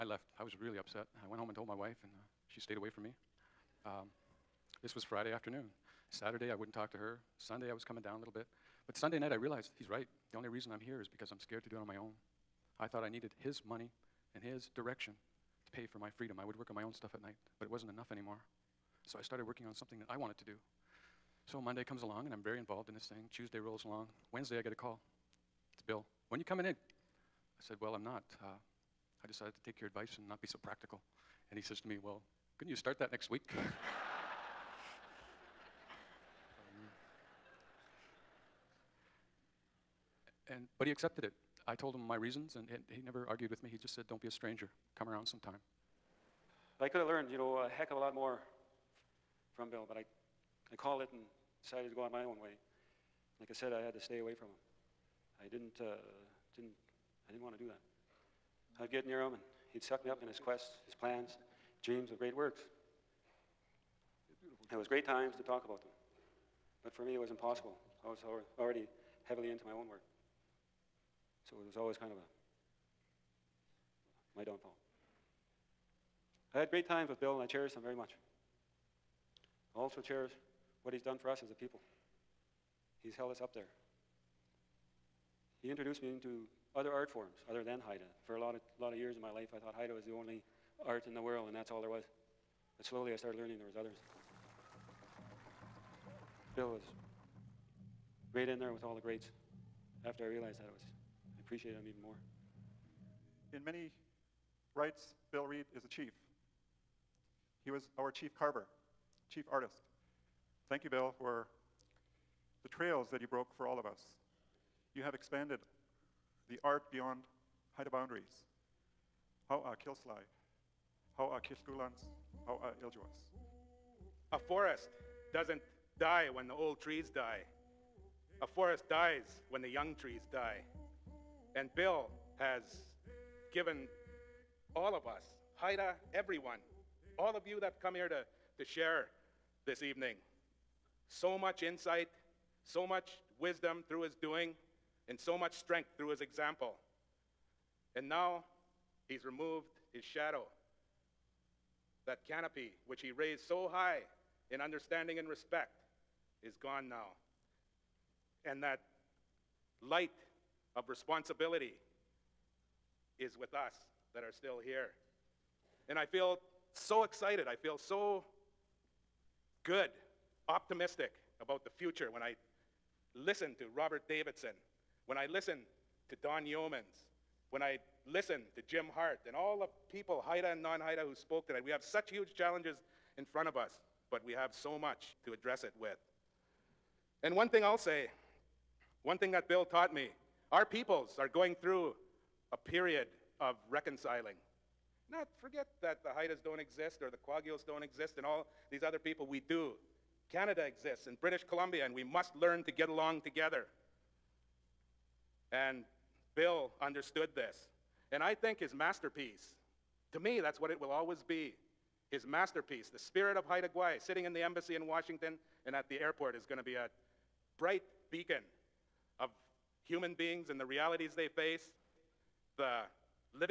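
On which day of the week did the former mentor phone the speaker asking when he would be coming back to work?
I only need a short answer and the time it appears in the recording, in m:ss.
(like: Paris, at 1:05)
Wednesday, at 0:24.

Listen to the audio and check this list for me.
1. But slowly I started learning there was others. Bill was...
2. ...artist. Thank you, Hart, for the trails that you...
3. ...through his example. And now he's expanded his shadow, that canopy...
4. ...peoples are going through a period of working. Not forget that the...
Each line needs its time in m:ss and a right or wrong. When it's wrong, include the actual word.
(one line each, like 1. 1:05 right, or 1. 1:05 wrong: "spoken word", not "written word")
1. 1:32 right
2. 1:49 wrong: "Bill", not "Hart"
3. 2:25 wrong: "removed", not "expanded"
4. 3:10 wrong: "reconciling", not "working".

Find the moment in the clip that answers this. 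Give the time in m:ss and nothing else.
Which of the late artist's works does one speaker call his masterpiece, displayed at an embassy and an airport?
3:32.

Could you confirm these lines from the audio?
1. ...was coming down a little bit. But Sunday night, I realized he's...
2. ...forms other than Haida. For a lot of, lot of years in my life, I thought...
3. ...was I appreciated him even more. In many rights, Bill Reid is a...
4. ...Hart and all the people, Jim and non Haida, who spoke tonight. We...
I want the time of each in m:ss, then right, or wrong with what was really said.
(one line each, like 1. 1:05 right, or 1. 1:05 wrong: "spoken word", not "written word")
1. 0:07 right
2. 1:27 right
3. 1:40 right
4. 2:58 wrong: "Haida", not "Jim".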